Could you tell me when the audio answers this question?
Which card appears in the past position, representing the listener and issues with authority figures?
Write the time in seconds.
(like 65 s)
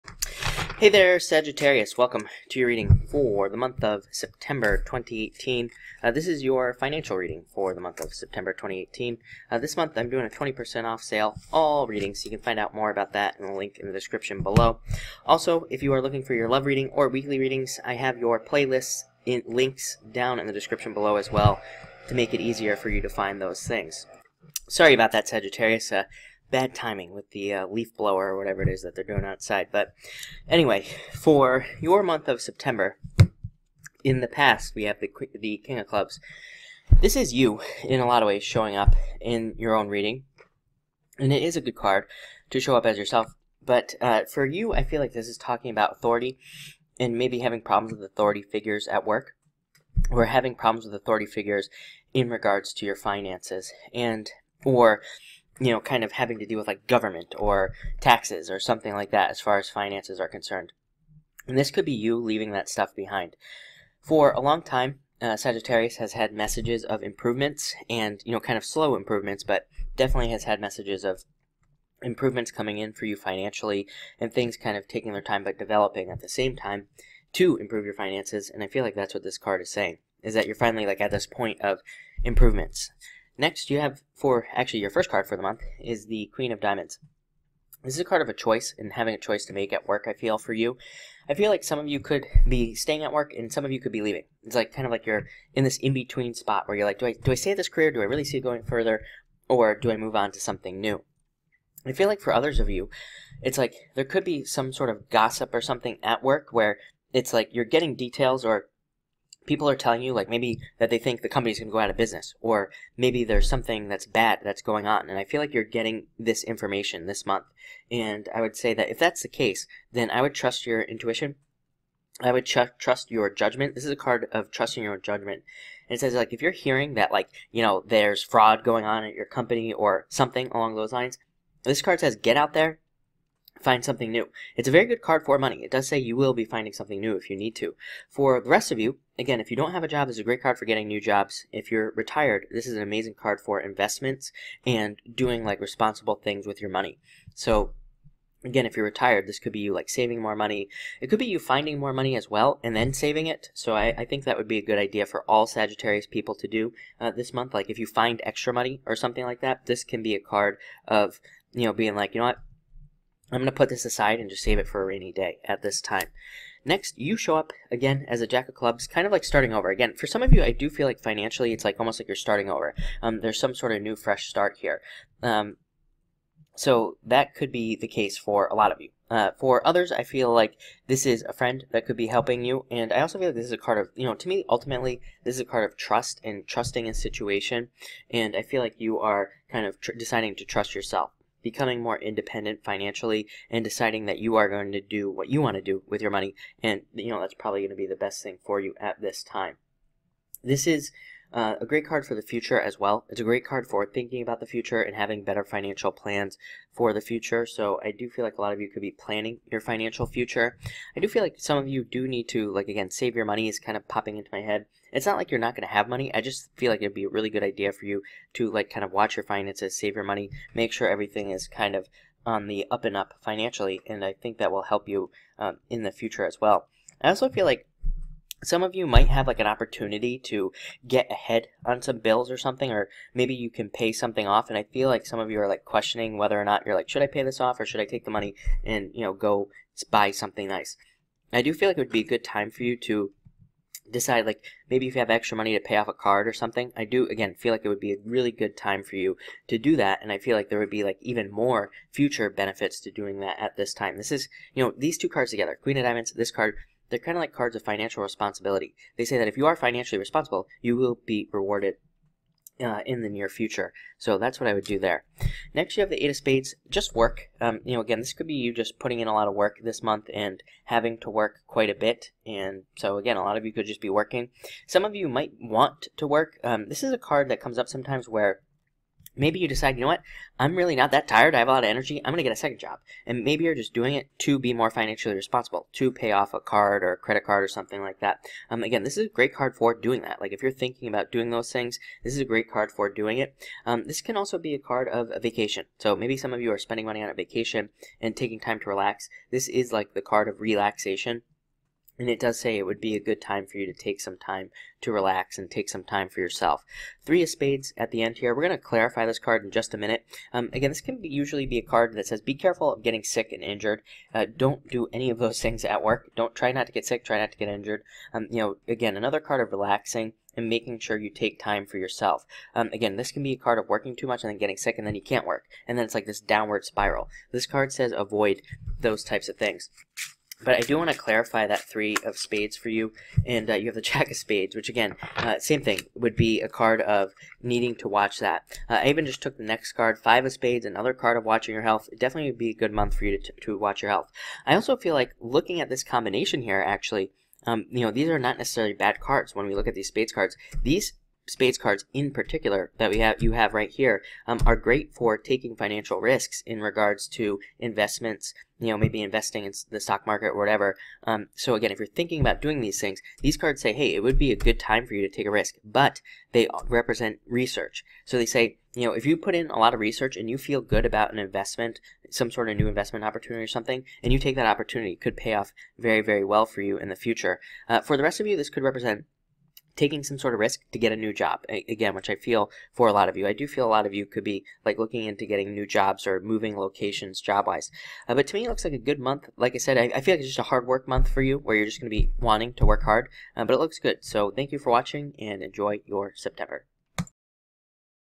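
35 s.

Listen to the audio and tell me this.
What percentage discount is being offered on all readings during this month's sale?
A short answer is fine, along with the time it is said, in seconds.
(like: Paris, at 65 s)
20%, at 10 s.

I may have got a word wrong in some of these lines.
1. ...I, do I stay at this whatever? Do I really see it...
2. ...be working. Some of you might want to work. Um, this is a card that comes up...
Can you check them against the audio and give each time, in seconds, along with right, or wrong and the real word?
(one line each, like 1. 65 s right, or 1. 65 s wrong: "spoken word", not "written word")
1. 97 s wrong: "career", not "whatever"
2. 273 s right.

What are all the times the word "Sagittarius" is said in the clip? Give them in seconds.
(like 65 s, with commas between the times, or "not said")
1 s, 25 s, 65 s, 155 s.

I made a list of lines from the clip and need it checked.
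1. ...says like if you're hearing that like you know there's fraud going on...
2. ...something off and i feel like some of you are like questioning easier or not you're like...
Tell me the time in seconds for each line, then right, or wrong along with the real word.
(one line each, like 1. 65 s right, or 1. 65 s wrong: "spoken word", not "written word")
1. 125 s right
2. 233 s wrong: "whether", not "easier".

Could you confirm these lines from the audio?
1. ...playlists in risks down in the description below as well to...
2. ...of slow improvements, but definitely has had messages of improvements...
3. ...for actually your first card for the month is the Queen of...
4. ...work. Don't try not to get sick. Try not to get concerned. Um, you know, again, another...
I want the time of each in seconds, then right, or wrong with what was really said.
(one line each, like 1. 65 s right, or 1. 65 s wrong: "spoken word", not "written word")
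1. 18 s wrong: "links", not "risks"
2. 68 s right
3. 84 s right
4. 315 s wrong: "injured", not "concerned".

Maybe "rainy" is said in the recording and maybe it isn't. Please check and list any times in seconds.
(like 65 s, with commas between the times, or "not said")
164 s.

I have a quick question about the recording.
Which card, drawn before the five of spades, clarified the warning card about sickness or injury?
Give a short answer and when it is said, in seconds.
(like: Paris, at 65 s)
Jack of Spades, at 333 s.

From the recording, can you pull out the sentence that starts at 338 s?
Uh, I even just took the next card, five of spades, another card of watching your health.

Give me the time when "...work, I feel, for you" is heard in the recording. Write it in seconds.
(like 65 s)
89 s.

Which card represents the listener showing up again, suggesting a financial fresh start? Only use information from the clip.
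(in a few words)
Jack of Clubs.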